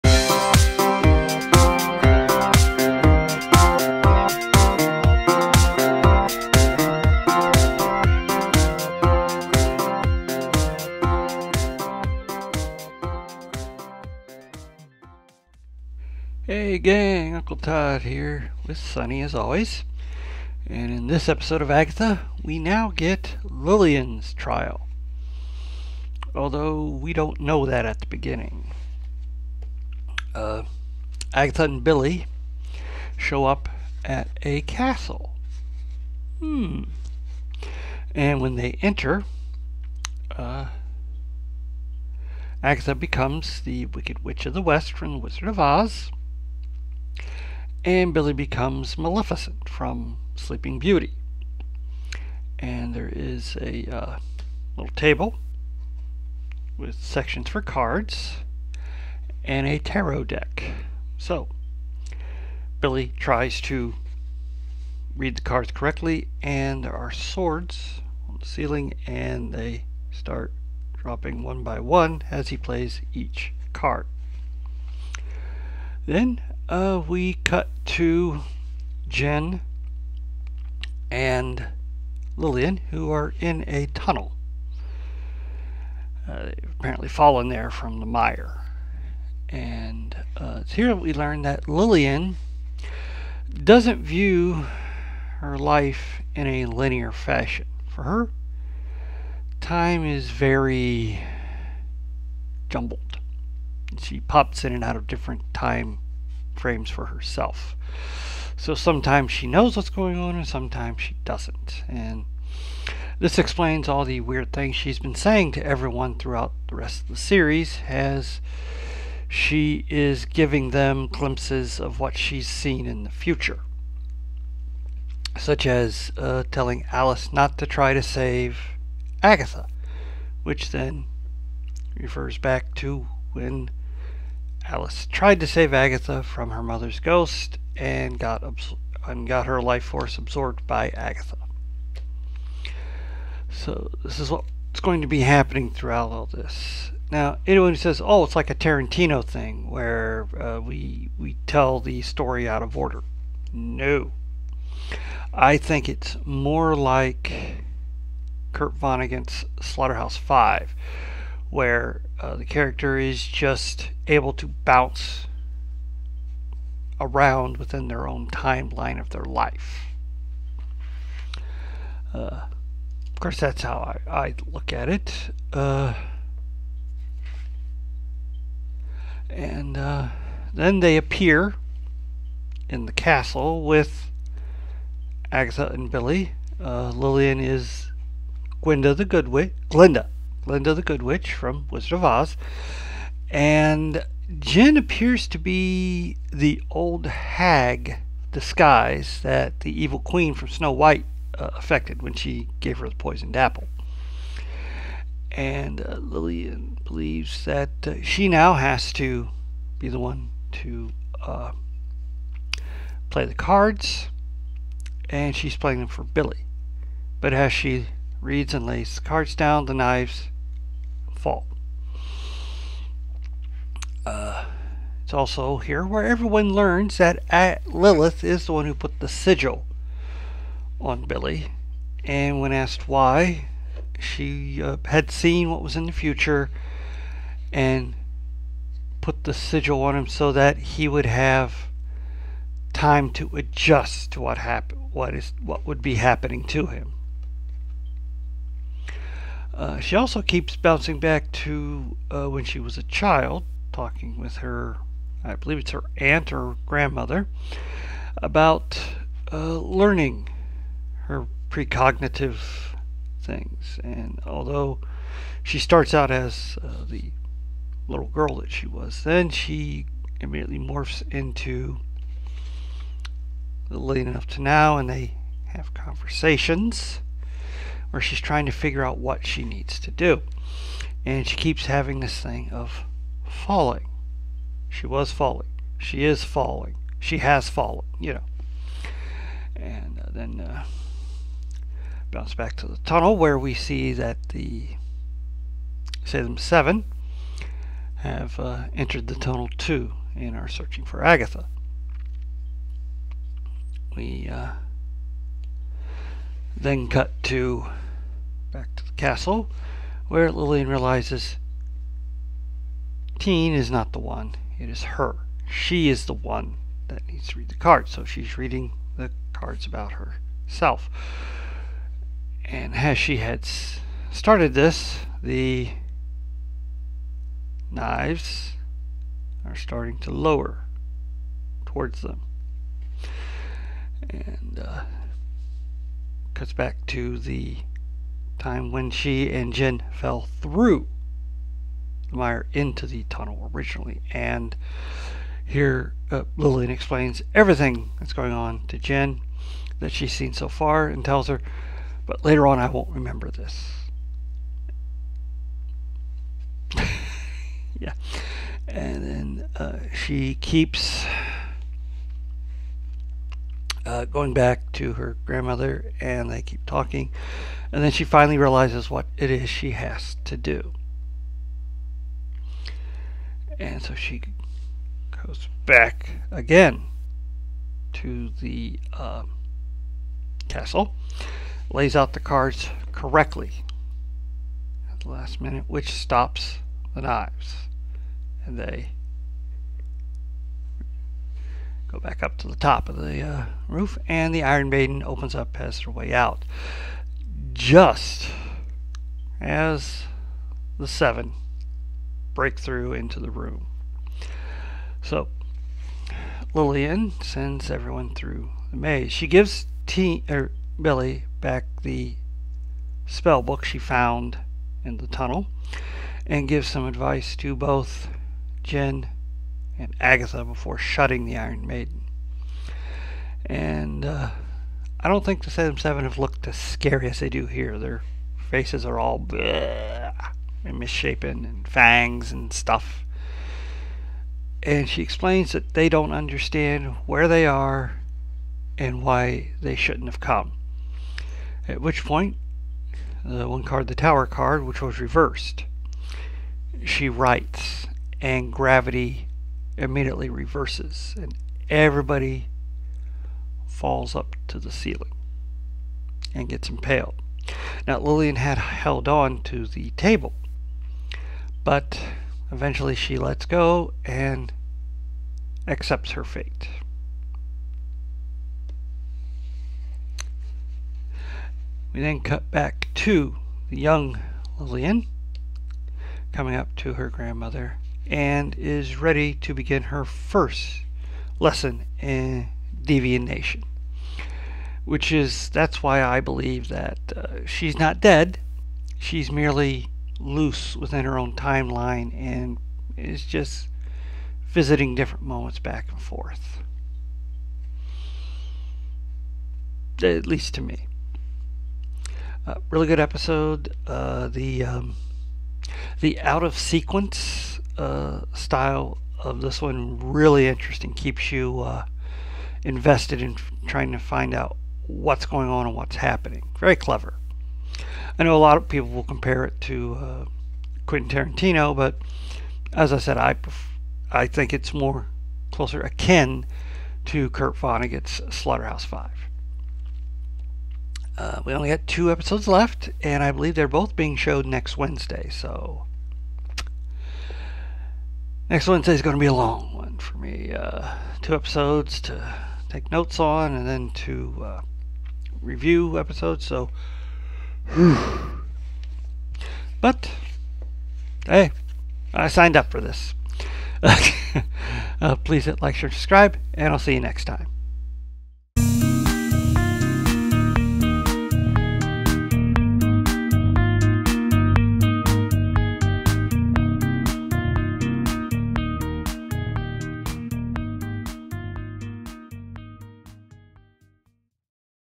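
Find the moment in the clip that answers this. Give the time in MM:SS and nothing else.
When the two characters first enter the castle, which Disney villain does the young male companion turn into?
00:48.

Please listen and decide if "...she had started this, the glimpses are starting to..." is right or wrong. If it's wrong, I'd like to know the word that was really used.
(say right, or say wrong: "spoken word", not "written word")
wrong: "knives", not "glimpses".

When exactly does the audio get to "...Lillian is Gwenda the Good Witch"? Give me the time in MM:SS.
03:06.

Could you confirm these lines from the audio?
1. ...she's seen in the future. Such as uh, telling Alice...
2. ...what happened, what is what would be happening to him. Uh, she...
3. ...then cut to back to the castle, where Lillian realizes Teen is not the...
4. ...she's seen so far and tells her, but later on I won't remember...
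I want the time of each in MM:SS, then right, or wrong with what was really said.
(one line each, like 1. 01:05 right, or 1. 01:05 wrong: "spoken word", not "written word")
1. 02:02 right
2. 04:04 right
3. 05:06 right
4. 05:49 right.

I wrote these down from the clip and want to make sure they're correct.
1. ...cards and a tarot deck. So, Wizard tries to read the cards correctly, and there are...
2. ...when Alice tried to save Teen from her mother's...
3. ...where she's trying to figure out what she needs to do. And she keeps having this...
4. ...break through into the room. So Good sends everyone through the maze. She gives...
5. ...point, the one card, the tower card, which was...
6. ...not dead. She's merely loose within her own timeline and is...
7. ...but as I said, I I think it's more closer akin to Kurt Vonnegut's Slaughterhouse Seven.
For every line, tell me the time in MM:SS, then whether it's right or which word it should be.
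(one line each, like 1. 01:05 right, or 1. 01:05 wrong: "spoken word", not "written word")
1. 00:57 wrong: "Billy", not "Wizard"
2. 02:13 wrong: "Agatha", not "Teen"
3. 04:37 right
4. 06:42 wrong: "Lillian", not "Good"
5. 07:22 right
6. 08:07 right
7. 08:41 wrong: "Five", not "Seven".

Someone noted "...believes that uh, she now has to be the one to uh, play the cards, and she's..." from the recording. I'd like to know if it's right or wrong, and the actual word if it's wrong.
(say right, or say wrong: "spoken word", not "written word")
right.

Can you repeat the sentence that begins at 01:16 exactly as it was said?
Then, uh, we cut to Jen and Lillian, who are in a tunnel.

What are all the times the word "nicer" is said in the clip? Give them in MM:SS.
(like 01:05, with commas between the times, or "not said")
not said.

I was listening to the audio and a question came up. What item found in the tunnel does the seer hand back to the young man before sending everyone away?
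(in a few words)
Spell book.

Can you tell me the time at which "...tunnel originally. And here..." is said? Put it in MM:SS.
05:43.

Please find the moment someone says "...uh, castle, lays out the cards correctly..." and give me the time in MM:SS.
06:18.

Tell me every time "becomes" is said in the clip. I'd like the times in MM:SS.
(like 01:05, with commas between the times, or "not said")
00:42, 00:48.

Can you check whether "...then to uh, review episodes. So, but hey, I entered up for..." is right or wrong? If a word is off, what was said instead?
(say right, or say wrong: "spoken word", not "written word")
wrong: "signed", not "entered".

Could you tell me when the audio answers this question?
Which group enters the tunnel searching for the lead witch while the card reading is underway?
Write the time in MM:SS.
04:56.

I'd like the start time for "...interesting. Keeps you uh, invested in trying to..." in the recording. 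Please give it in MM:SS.
08:30.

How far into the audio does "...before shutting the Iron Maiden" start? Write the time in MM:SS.
07:00.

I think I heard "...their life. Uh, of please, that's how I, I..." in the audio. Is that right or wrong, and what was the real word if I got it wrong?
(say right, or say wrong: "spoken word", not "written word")
wrong: "course", not "please".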